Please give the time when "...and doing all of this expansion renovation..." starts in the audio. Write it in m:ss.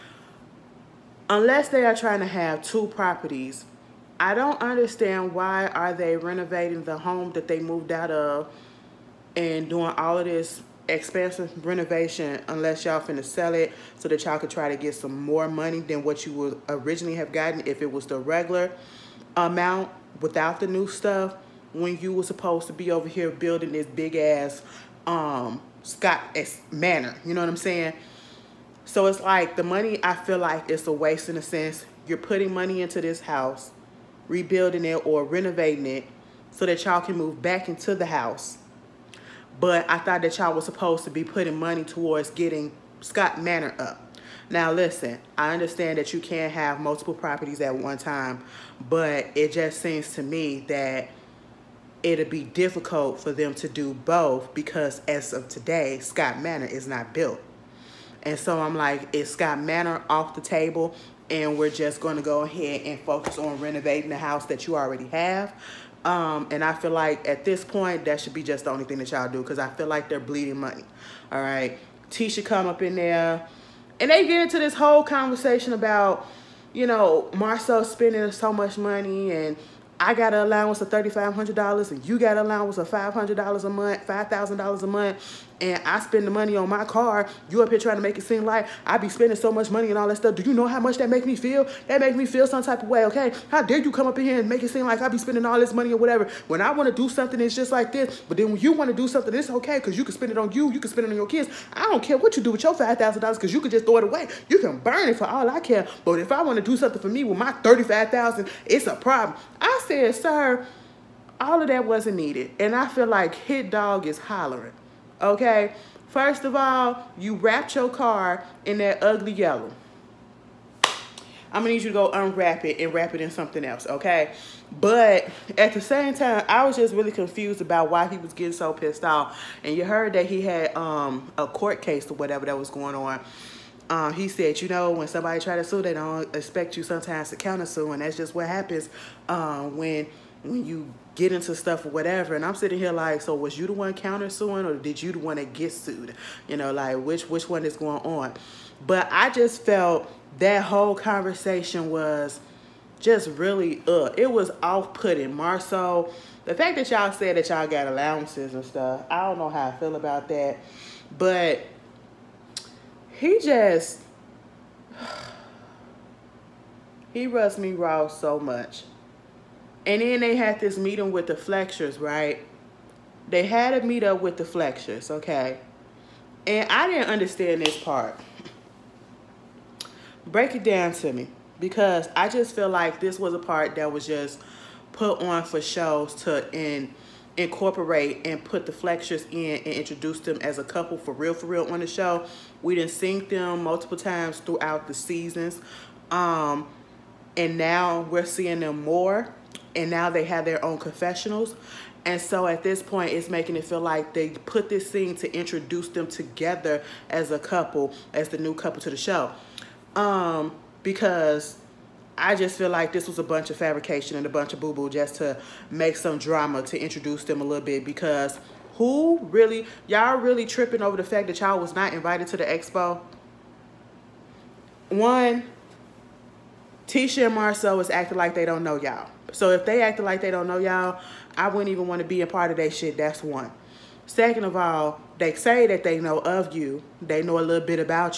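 0:09.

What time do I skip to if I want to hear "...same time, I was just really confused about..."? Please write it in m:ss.
2:05.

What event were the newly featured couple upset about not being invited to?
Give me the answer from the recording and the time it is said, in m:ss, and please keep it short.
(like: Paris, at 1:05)
The expo, at 3:42.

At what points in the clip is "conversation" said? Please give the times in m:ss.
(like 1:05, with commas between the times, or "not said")
1:15, 2:30.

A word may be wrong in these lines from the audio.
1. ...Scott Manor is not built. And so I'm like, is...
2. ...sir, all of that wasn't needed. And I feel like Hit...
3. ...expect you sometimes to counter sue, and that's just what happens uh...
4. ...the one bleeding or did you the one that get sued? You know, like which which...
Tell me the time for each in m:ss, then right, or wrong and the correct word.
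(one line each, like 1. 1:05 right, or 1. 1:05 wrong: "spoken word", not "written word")
1. 0:55 right
2. 1:50 right
3. 2:16 right
4. 2:23 wrong: "countersuing", not "bleeding".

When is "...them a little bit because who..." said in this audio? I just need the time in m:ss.
3:37.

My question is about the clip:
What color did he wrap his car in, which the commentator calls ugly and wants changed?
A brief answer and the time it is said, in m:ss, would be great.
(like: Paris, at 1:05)
Yellow, at 1:59.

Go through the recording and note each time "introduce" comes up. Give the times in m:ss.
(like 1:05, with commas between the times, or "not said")
3:09, 3:25, 3:36.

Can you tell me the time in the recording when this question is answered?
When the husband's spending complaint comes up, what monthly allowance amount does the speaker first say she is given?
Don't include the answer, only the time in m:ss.
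1:20.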